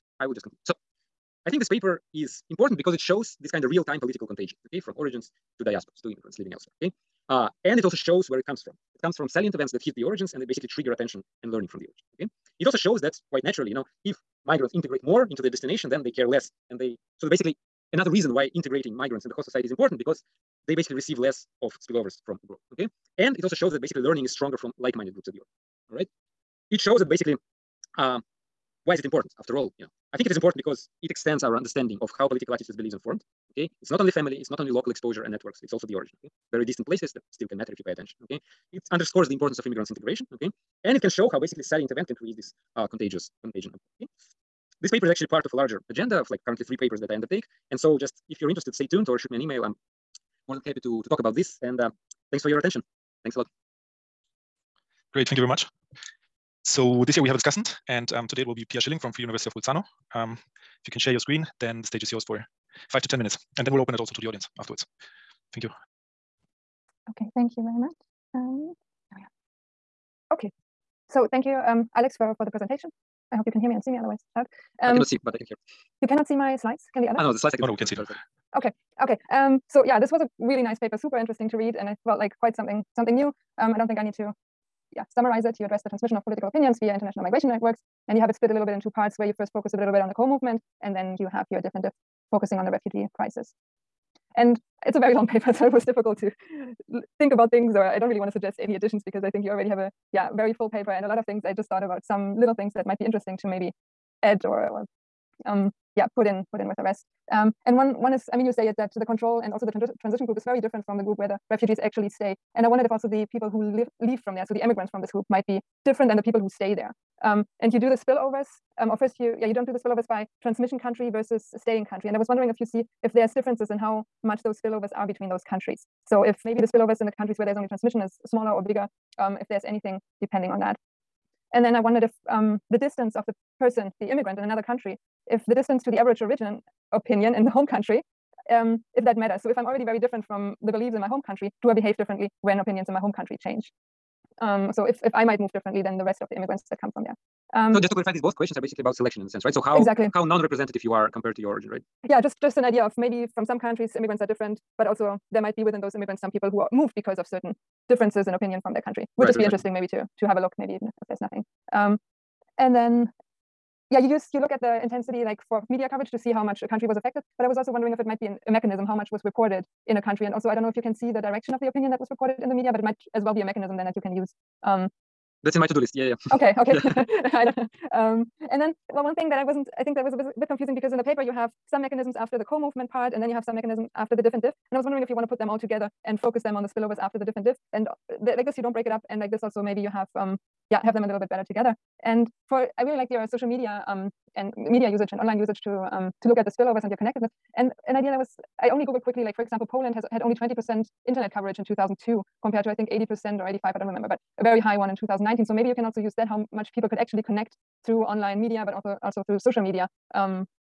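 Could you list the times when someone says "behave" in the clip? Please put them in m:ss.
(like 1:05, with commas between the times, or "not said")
2:21.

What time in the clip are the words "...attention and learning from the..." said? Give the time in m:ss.
0:10.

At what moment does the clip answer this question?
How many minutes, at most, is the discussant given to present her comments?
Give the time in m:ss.
1:03.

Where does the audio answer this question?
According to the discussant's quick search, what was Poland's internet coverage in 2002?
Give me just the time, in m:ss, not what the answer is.
3:20.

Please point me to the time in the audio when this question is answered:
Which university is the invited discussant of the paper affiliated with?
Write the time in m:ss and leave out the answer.
0:59.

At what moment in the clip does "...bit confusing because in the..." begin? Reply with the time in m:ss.
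3:00.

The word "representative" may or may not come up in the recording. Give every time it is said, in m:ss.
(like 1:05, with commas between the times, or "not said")
2:30.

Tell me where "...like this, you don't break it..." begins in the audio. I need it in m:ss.
3:08.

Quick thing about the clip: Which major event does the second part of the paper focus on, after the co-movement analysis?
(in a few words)
the refugee crisis.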